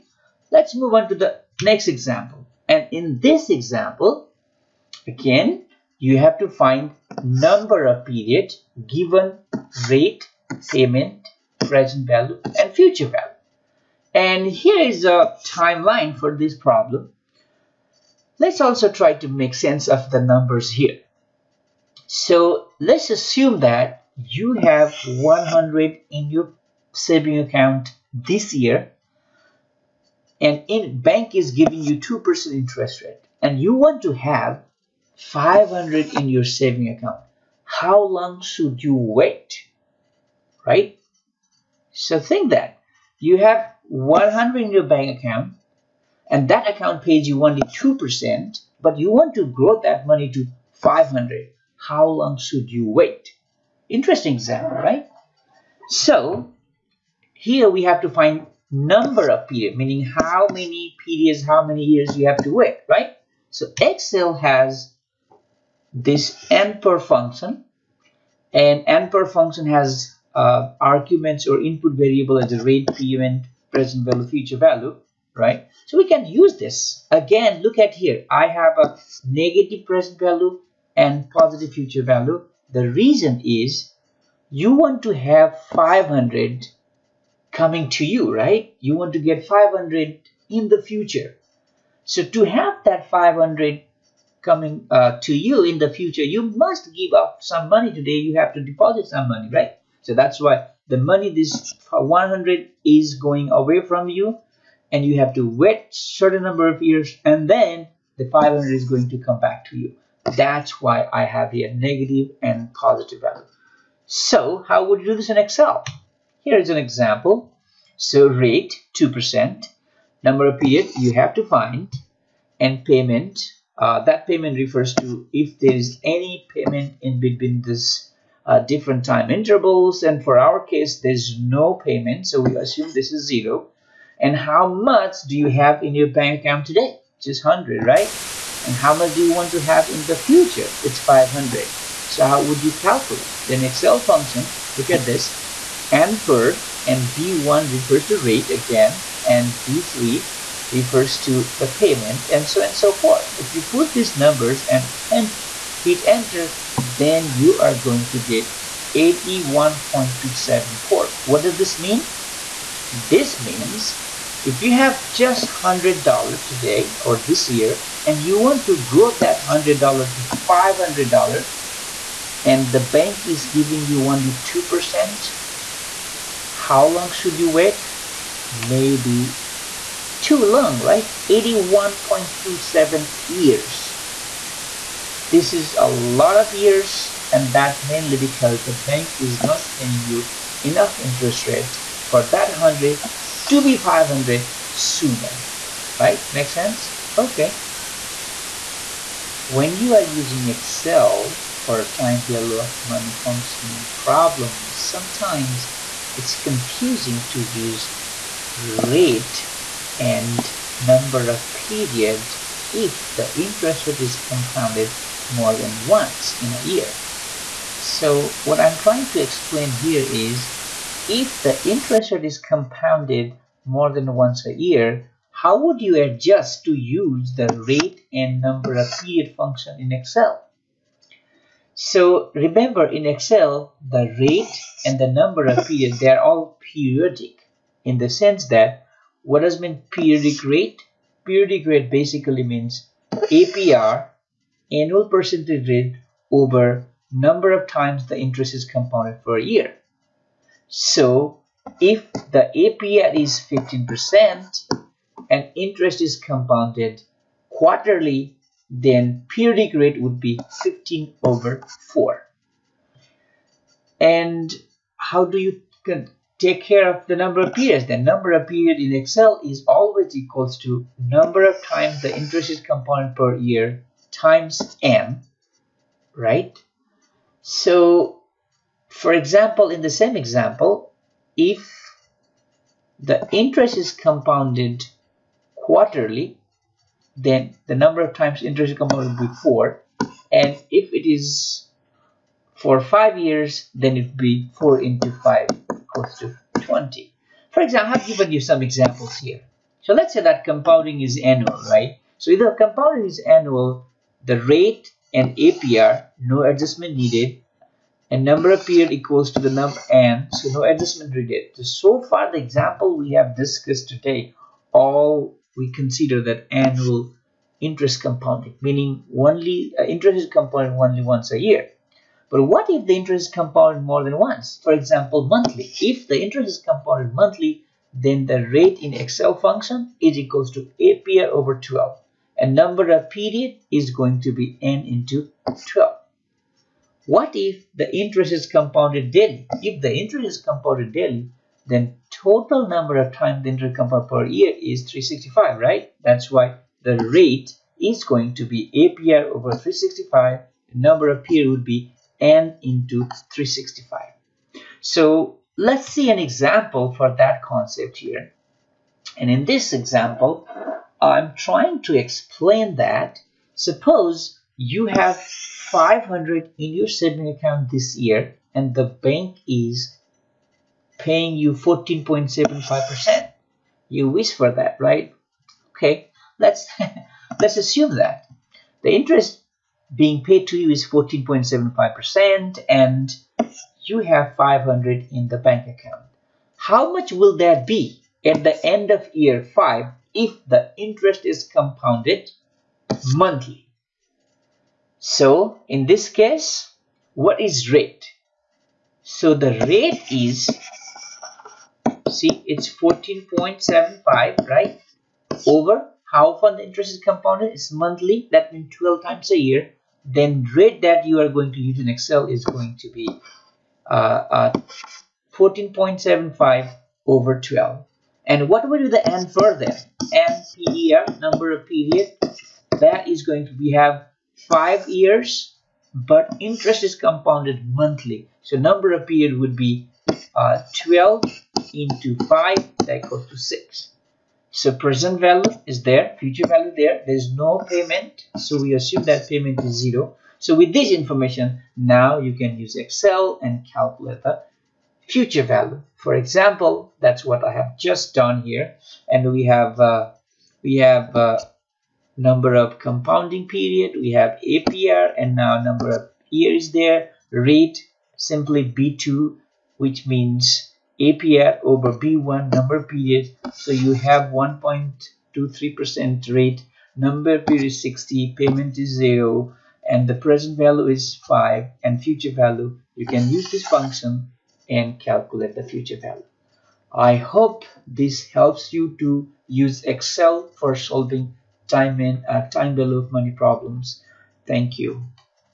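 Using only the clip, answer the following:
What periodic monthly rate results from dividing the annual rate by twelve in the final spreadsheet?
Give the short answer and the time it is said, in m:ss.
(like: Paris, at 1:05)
1.23%, at 7:44.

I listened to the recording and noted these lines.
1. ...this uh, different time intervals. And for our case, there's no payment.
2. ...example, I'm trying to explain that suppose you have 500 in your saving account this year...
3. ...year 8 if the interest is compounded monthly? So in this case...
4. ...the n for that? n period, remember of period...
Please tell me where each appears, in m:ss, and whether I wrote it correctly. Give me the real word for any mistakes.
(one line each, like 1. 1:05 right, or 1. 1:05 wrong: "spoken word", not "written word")
1. 2:07 right
2. 5:59 right
3. 6:29 wrong: "5", not "8"
4. 6:58 wrong: "number", not "remember".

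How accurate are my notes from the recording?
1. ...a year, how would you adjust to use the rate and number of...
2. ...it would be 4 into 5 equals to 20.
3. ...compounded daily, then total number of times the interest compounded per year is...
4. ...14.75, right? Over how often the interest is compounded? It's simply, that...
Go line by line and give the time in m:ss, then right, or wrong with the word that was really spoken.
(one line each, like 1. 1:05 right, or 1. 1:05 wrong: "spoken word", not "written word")
1. 3:44 right
2. 4:53 right
3. 5:40 right
4. 6:42 wrong: "monthly", not "simply".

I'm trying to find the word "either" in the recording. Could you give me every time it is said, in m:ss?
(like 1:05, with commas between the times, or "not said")
5:02.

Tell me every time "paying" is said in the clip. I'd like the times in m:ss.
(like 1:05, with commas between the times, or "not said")
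3:09, 6:10.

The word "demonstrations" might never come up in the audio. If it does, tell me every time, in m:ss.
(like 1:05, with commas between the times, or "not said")
not said.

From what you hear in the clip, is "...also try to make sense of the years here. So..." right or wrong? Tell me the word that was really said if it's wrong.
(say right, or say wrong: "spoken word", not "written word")
wrong: "numbers", not "years".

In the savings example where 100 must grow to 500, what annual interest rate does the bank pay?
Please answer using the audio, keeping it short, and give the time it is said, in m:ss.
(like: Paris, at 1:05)
2%, at 0:31.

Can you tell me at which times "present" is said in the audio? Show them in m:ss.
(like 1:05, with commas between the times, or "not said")
0:11, 1:13, 1:19, 7:14, 7:50.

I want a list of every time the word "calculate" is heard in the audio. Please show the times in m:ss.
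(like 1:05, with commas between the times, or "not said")
2:22, 7:23, 7:54.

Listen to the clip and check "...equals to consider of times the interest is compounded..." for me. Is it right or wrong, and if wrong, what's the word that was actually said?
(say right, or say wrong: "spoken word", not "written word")
wrong: "number", not "consider".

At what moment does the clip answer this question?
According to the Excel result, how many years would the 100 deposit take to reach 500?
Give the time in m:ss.
2:38.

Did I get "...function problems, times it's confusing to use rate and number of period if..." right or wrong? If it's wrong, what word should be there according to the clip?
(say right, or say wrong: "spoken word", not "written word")
wrong: "sometimes", not "times".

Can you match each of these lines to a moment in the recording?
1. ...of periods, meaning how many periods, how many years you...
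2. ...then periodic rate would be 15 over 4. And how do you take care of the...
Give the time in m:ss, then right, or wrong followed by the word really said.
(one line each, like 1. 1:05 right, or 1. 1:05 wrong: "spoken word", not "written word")
1. 0:59 right
2. 4:18 right.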